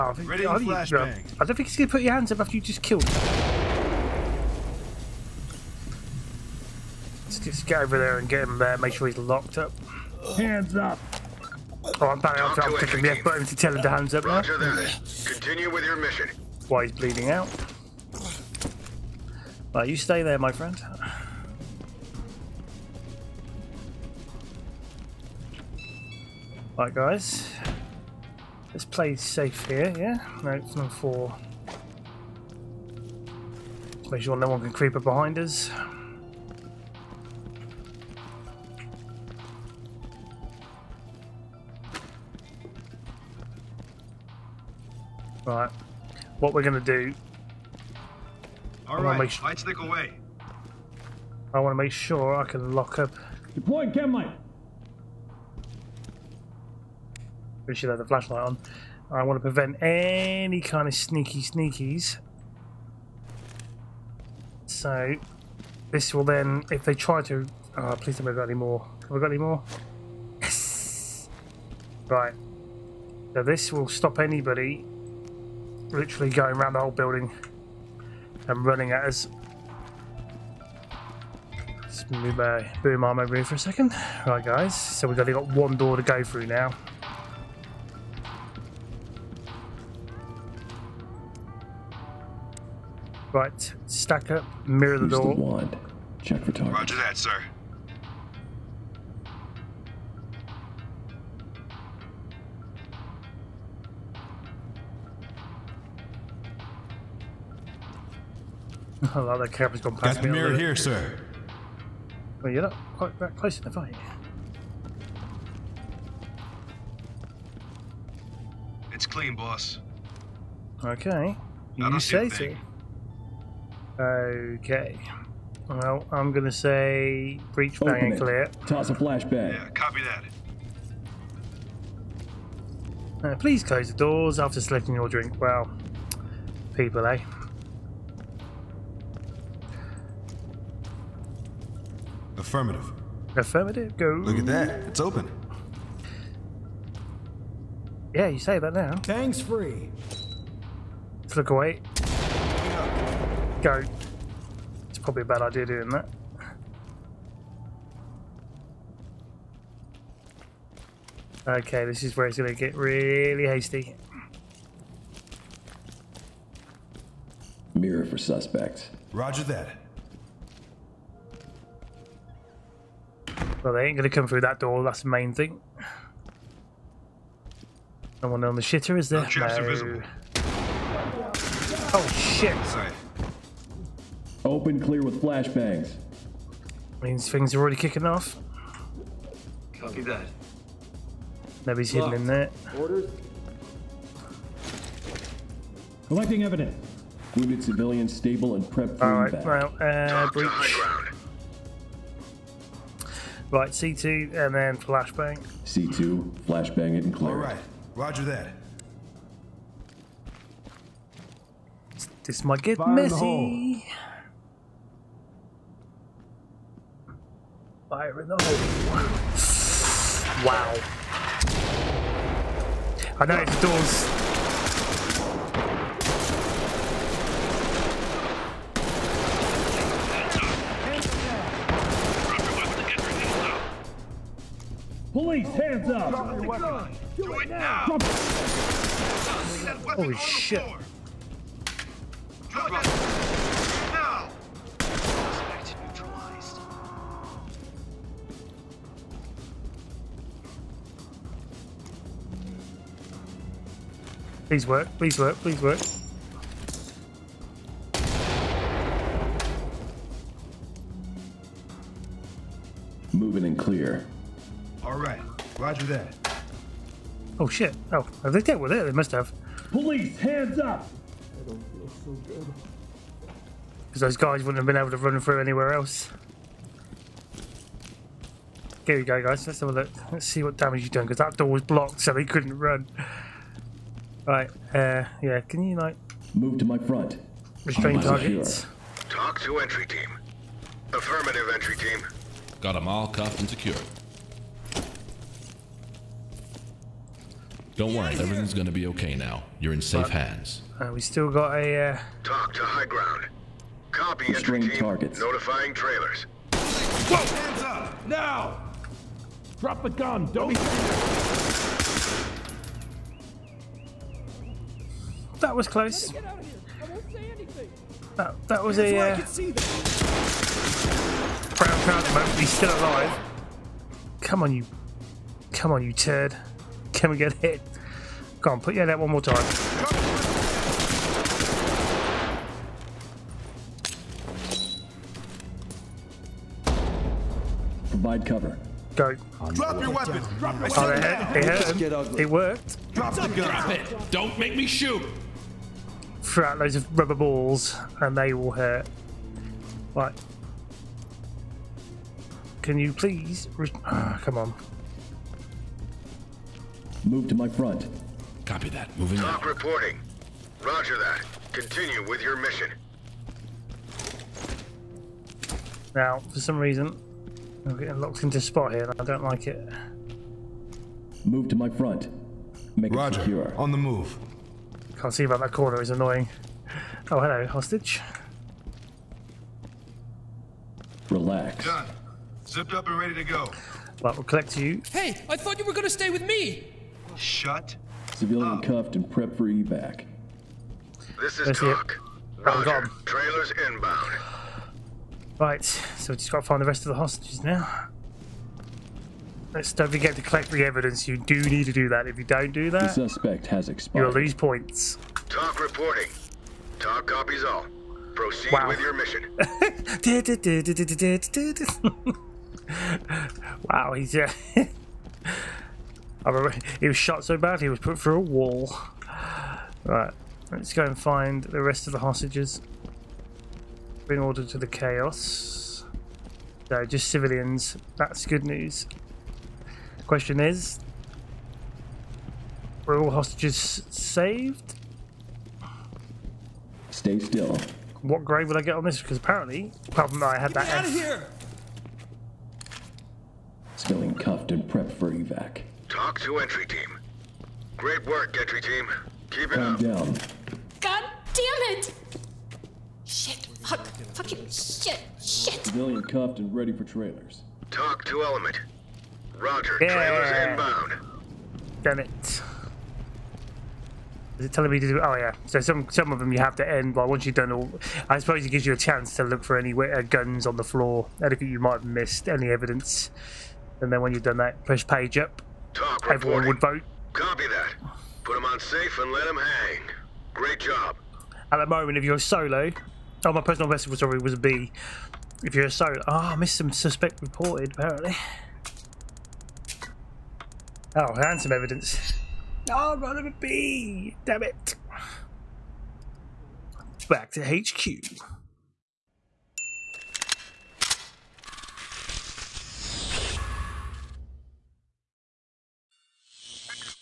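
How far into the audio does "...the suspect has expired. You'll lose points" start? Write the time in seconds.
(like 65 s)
402 s.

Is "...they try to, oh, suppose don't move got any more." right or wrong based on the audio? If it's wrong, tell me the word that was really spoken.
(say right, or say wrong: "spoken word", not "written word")
wrong: "please", not "suppose".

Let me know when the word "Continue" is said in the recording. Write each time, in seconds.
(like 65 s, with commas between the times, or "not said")
15 s, 361 s.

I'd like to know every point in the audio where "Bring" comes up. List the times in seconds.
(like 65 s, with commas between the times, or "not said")
424 s.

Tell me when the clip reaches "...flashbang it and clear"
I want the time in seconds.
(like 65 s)
206 s.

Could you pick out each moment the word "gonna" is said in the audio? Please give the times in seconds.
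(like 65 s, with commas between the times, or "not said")
46 s, 298 s.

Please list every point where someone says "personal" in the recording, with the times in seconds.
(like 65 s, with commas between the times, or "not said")
483 s.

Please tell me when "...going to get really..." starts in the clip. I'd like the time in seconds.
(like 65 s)
162 s.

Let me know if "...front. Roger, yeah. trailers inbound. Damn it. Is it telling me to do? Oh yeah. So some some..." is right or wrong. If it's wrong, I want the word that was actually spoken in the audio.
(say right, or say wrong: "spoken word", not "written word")
wrong: "element", not "front".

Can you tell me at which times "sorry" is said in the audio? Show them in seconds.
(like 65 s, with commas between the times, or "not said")
483 s.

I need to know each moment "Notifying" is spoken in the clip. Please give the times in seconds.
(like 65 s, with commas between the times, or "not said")
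305 s.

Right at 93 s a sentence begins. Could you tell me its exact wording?
Right, stack up, mirror the Use door.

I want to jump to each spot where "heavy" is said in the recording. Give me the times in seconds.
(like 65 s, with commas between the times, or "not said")
not said.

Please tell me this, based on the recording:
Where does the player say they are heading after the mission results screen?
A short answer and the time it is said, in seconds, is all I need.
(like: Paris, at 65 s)
HQ, at 497 s.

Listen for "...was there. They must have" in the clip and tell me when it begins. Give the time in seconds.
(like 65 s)
268 s.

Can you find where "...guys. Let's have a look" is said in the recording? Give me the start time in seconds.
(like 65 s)
279 s.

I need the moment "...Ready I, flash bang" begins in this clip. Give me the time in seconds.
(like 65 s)
0 s.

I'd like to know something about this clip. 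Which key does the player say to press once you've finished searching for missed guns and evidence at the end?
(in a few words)
Page up.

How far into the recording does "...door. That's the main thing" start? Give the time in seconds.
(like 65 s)
174 s.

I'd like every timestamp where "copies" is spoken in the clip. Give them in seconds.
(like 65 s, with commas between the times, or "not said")
407 s.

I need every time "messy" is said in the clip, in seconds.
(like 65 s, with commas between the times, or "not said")
212 s.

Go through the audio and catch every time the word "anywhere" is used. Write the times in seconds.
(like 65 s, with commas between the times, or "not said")
275 s.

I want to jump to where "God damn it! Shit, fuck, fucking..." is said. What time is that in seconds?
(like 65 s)
450 s.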